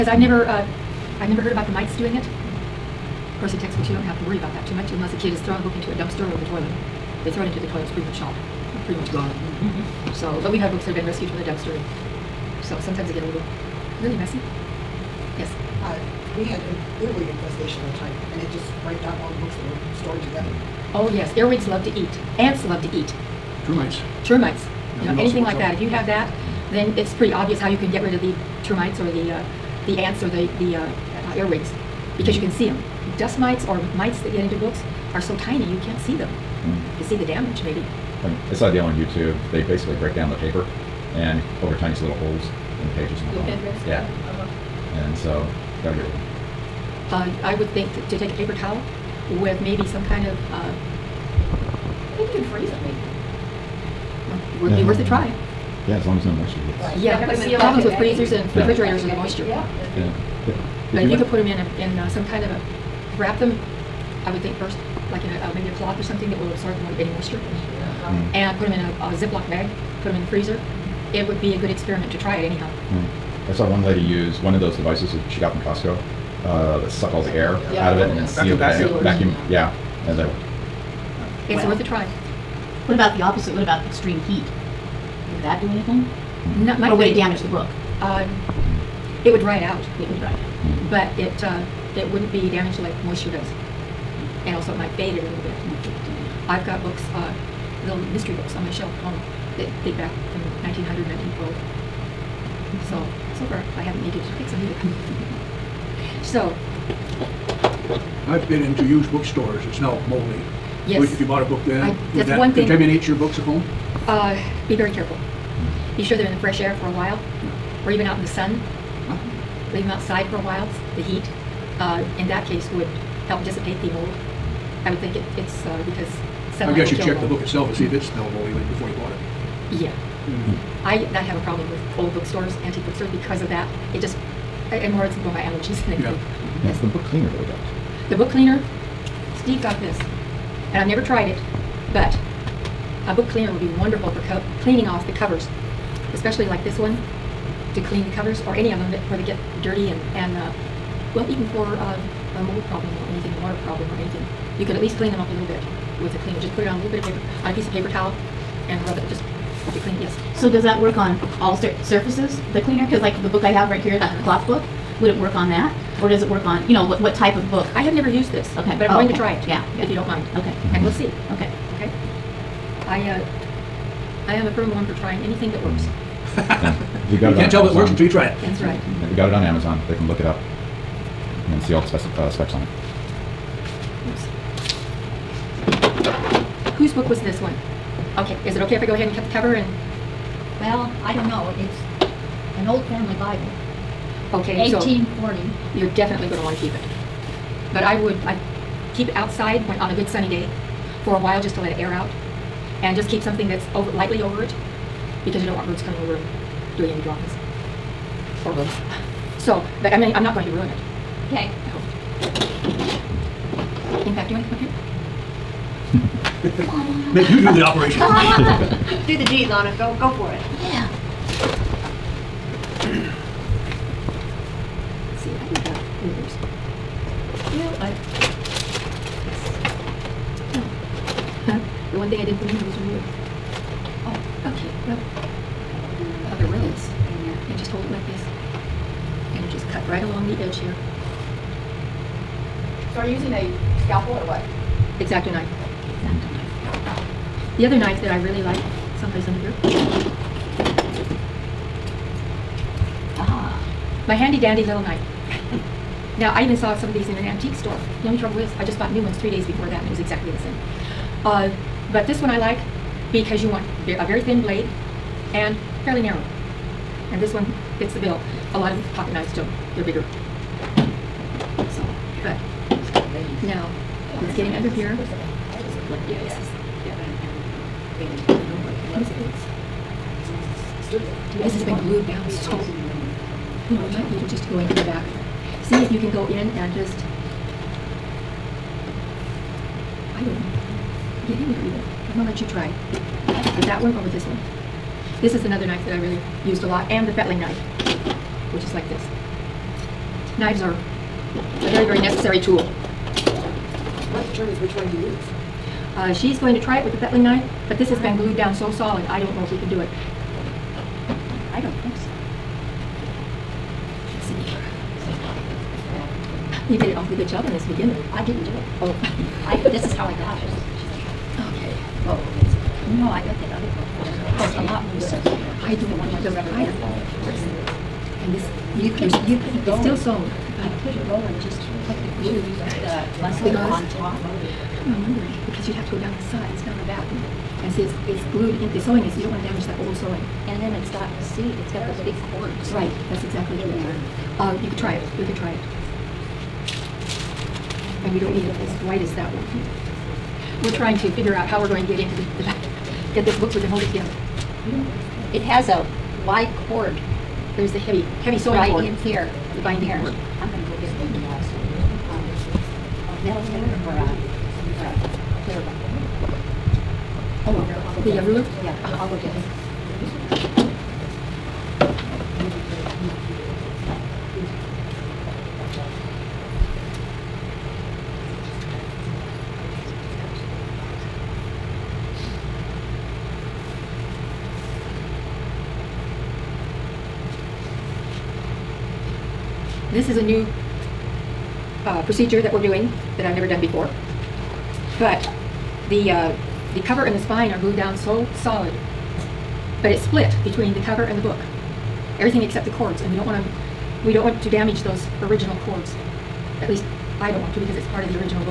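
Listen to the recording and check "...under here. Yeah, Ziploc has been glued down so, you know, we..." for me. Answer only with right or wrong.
wrong.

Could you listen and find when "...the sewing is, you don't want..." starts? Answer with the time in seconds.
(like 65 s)
338 s.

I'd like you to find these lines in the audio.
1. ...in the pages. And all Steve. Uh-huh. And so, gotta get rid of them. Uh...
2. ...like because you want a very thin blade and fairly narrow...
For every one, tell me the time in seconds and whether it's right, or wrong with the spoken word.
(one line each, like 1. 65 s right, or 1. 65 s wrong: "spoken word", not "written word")
1. 42 s wrong: "Yeah", not "Steve"
2. 262 s right.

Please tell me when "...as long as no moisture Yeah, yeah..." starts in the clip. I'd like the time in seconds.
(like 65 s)
55 s.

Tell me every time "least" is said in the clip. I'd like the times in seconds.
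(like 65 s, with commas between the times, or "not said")
154 s, 406 s.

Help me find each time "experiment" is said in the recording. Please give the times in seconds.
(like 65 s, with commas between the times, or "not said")
71 s.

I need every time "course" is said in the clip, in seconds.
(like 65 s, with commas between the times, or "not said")
3 s, 324 s.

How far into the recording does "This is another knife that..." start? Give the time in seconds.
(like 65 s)
295 s.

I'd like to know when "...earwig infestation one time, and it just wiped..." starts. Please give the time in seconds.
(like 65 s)
17 s.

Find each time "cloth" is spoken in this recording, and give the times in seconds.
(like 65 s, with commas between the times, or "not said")
65 s, 164 s.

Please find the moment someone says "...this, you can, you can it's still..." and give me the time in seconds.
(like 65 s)
328 s.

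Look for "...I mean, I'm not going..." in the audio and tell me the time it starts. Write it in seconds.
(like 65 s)
209 s.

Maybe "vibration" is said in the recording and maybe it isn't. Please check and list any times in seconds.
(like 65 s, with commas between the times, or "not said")
not said.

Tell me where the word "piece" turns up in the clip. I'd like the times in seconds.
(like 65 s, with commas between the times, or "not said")
157 s.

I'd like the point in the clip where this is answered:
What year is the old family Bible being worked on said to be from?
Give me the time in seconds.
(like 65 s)
194 s.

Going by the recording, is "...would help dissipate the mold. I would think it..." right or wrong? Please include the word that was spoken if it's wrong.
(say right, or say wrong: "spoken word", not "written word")
right.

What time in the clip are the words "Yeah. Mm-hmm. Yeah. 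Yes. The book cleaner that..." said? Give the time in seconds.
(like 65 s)
136 s.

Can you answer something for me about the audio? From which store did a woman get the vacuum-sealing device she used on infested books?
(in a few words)
Costco.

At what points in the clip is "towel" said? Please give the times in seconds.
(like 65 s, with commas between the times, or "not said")
48 s, 157 s.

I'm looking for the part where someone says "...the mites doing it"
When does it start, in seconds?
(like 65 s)
1 s.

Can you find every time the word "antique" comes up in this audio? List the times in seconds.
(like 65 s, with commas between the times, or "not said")
132 s, 257 s.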